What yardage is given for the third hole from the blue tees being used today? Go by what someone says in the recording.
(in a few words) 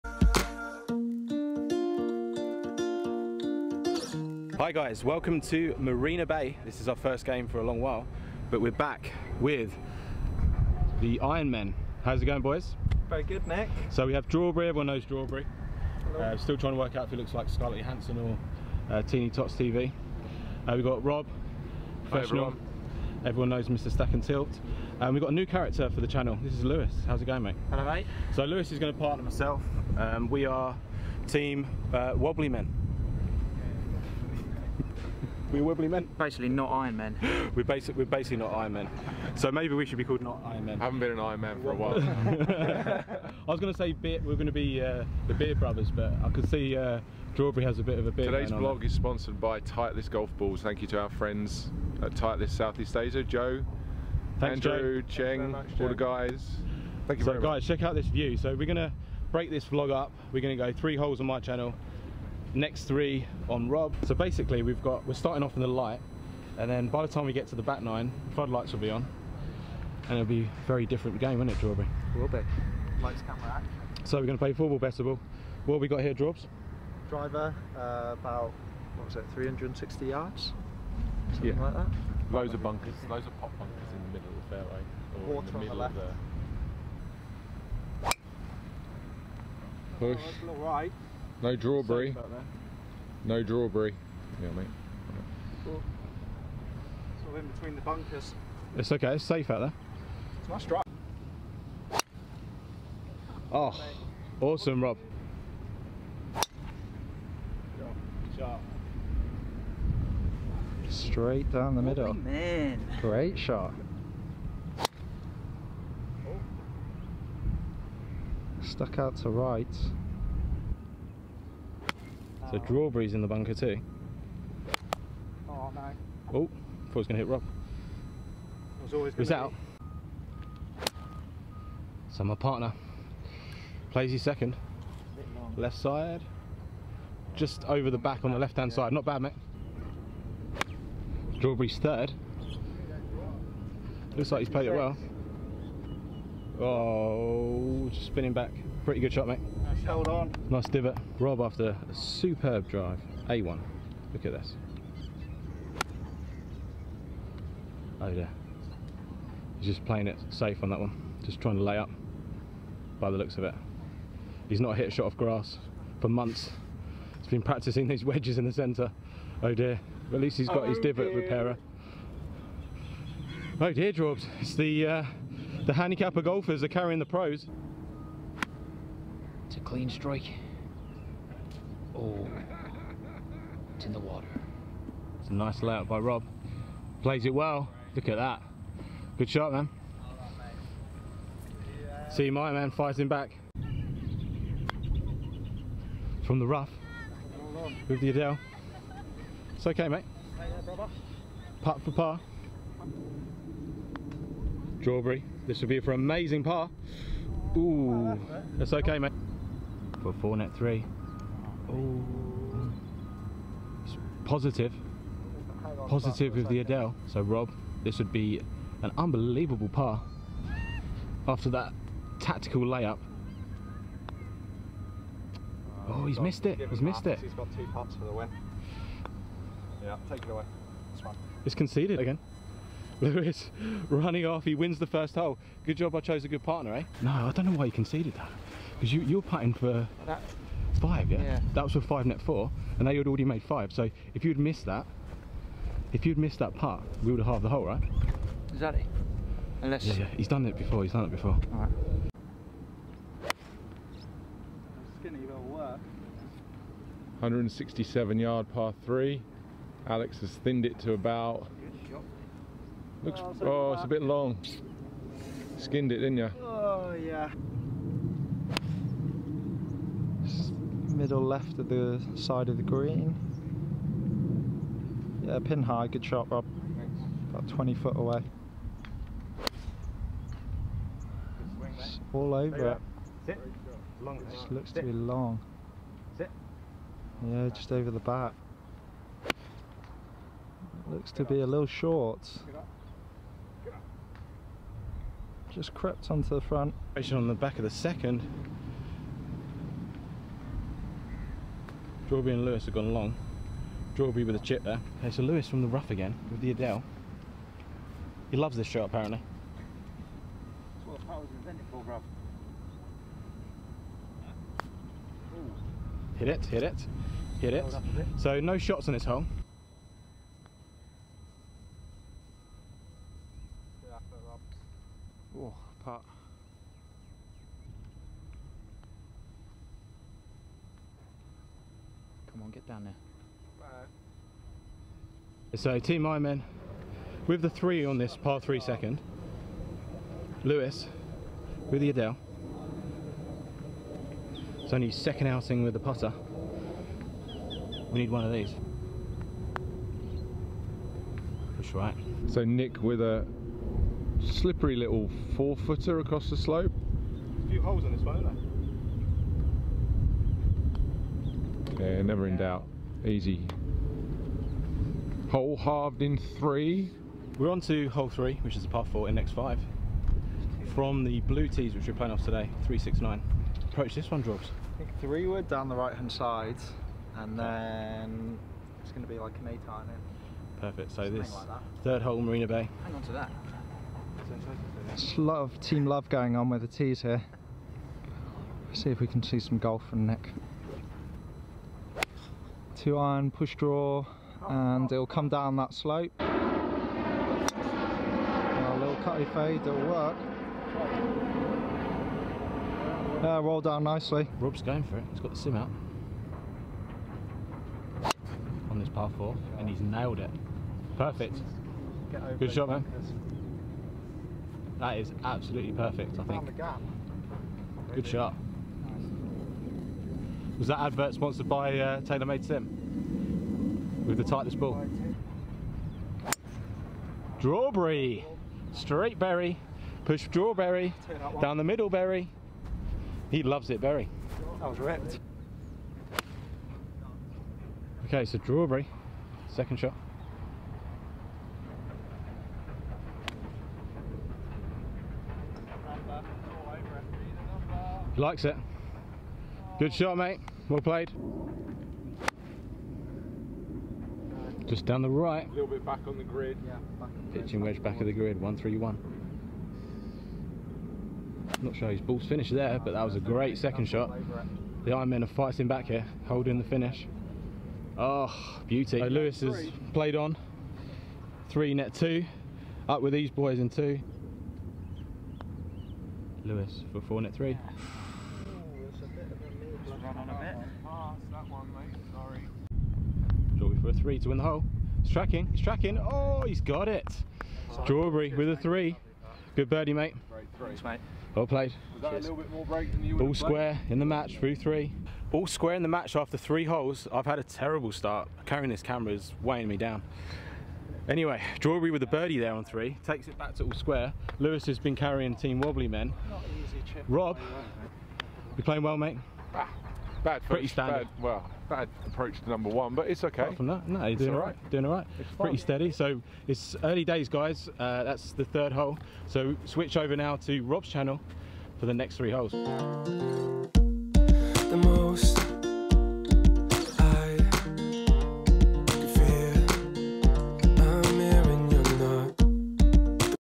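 369.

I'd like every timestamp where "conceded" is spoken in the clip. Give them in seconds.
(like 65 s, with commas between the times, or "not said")
231 s, 237 s.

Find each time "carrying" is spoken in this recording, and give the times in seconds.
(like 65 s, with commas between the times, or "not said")
176 s, 498 s, 504 s.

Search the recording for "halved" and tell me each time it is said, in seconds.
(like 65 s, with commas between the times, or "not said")
247 s, 365 s.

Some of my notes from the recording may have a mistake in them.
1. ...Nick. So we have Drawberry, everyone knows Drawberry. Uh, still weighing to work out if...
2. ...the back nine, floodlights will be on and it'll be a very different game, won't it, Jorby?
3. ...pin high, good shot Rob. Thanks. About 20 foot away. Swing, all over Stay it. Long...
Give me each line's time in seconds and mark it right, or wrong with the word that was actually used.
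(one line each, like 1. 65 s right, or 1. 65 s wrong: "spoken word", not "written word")
1. 13 s wrong: "trying", not "weighing"
2. 67 s right
3. 275 s right.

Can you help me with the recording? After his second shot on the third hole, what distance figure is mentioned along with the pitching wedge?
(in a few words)
131.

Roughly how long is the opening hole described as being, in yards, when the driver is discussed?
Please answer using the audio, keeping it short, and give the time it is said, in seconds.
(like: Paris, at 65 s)
360 yards, at 79 s.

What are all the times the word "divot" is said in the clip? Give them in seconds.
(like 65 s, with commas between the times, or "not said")
150 s, 170 s.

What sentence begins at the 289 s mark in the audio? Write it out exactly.
It looks to be a little short.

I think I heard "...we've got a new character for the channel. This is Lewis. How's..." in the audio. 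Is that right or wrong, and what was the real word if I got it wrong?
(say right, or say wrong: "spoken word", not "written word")
right.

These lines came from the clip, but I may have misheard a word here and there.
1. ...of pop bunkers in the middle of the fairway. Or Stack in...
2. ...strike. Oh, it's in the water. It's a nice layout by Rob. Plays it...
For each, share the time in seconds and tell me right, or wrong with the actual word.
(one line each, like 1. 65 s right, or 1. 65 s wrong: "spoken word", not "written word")
1. 83 s wrong: "Water", not "Stack"
2. 179 s right.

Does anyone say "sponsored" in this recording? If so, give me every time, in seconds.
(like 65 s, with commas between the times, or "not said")
48 s, 421 s.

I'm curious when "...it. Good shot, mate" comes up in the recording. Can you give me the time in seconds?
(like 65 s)
448 s.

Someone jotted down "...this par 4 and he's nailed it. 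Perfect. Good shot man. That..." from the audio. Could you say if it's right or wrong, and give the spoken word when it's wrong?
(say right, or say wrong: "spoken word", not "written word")
right.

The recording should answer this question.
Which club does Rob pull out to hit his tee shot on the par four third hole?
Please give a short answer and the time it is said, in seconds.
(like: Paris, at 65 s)
the sim, at 405 s.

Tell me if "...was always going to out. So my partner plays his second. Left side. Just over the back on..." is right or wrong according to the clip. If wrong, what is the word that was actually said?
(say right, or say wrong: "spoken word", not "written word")
right.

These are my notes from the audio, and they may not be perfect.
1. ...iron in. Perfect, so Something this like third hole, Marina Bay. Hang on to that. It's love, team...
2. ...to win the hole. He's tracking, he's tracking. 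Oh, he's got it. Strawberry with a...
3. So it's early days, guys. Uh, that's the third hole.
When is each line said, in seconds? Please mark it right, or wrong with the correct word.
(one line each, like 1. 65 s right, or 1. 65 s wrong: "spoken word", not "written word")
1. 379 s right
2. 484 s right
3. 515 s right.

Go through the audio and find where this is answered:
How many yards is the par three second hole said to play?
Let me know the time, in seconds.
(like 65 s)
257 s.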